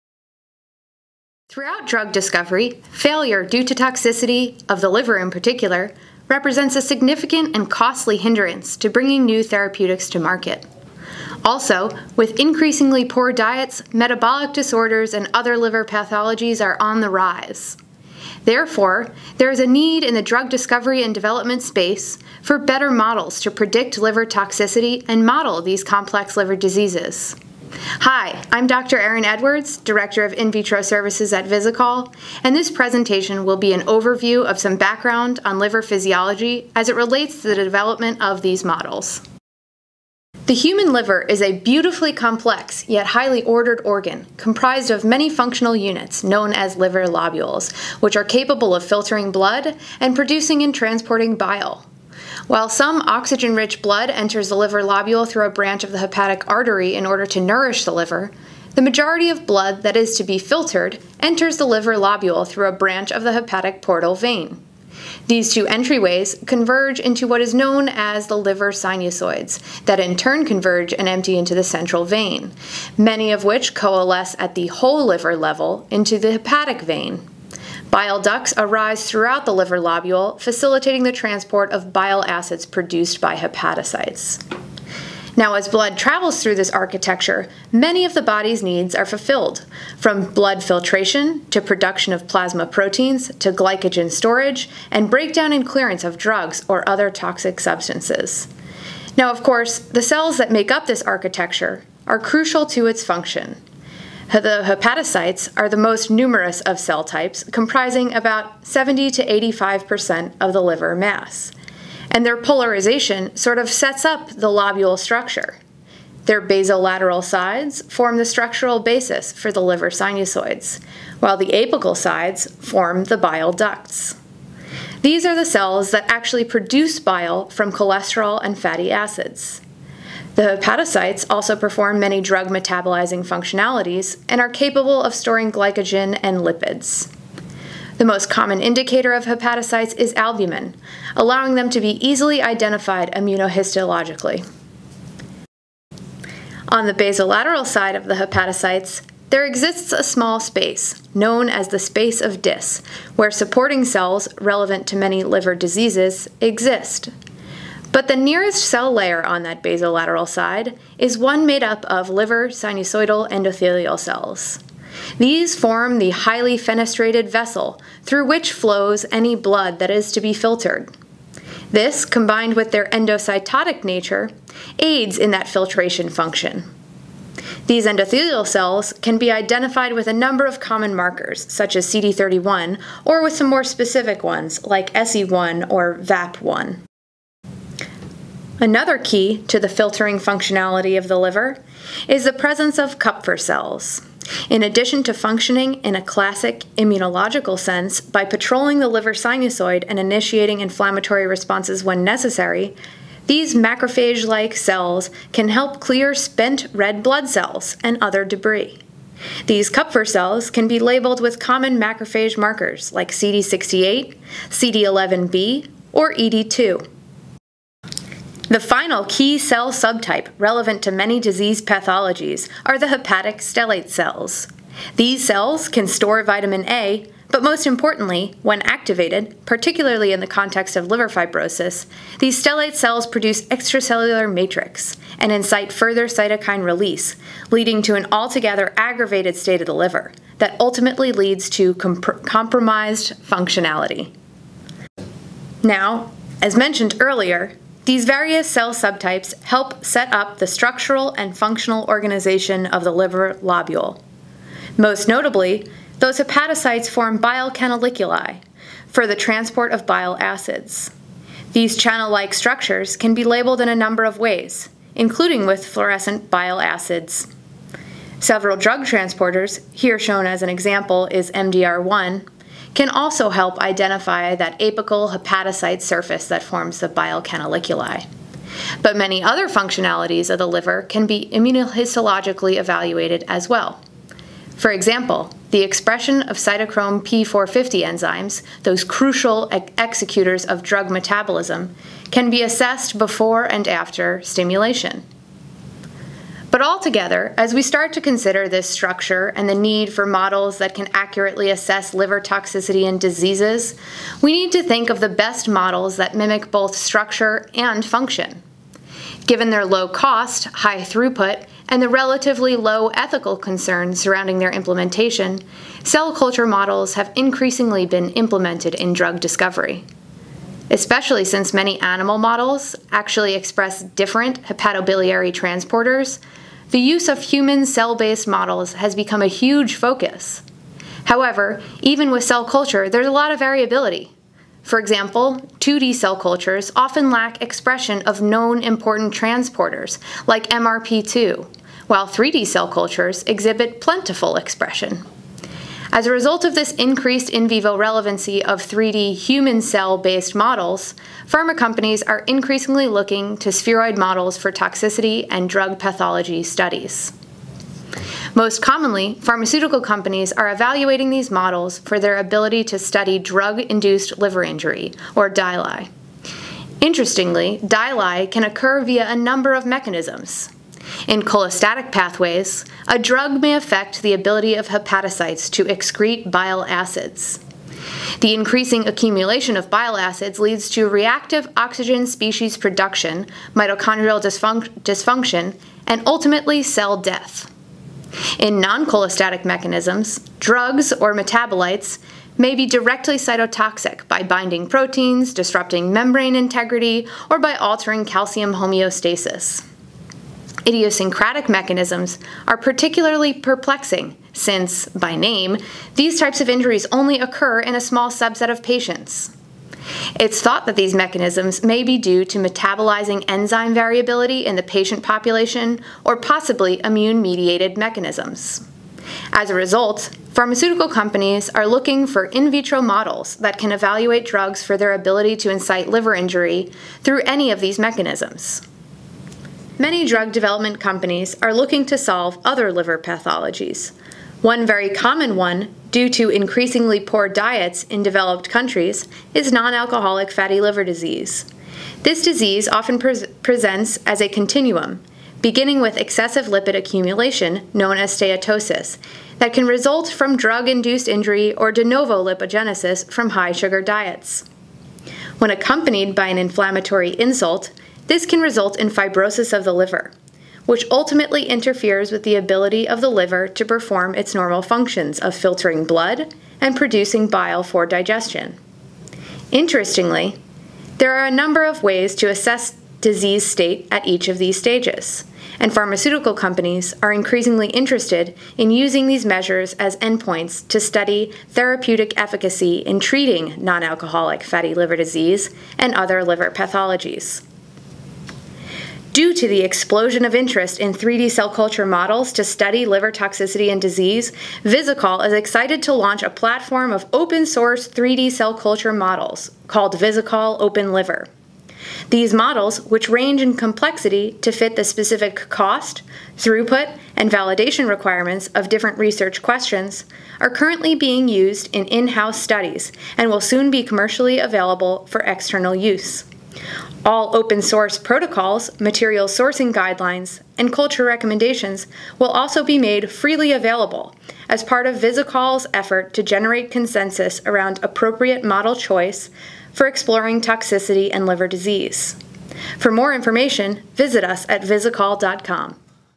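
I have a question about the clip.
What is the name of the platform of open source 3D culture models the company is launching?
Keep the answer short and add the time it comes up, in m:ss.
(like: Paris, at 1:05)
Visikol Open Liver, at 8:19.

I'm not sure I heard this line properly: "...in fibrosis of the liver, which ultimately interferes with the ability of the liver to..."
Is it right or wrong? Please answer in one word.
right.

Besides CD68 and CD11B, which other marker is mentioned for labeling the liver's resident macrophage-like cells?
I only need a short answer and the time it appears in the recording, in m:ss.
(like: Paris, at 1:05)
ED2, at 3:36.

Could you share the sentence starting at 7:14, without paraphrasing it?
One very common one, due to increasingly poor diets in developed countries, is non alcoholic fatty liver disease.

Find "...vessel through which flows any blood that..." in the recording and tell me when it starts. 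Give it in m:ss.
2:47.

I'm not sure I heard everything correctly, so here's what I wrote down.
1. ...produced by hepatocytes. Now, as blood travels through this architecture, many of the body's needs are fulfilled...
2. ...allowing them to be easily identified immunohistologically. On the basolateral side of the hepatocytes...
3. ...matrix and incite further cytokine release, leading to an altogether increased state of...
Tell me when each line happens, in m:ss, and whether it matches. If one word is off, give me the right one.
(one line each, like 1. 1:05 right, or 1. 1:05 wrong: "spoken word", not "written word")
1. 1:22 right
2. 2:21 right
3. 3:54 wrong: "aggravated", not "increased".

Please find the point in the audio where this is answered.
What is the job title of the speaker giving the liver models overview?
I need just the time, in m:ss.
0:29.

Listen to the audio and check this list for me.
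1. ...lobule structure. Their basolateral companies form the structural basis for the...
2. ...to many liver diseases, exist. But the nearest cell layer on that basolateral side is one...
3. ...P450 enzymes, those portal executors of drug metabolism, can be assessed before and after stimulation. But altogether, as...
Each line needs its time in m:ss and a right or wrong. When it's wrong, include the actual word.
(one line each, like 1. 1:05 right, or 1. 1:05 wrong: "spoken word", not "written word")
1. 1:54 wrong: "sides", not "companies"
2. 2:34 right
3. 4:47 wrong: "crucial", not "portal".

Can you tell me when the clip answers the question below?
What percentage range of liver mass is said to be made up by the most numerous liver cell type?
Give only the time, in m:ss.
1:48.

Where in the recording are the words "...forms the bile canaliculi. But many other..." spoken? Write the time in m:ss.
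4:36.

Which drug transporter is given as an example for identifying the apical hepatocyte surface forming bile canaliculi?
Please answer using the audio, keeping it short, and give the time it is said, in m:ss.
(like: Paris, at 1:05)
MDR1, at 4:31.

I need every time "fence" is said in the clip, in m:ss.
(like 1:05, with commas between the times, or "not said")
not said.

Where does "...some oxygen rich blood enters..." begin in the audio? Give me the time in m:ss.
0:52.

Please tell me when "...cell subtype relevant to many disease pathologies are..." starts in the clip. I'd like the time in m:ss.
3:39.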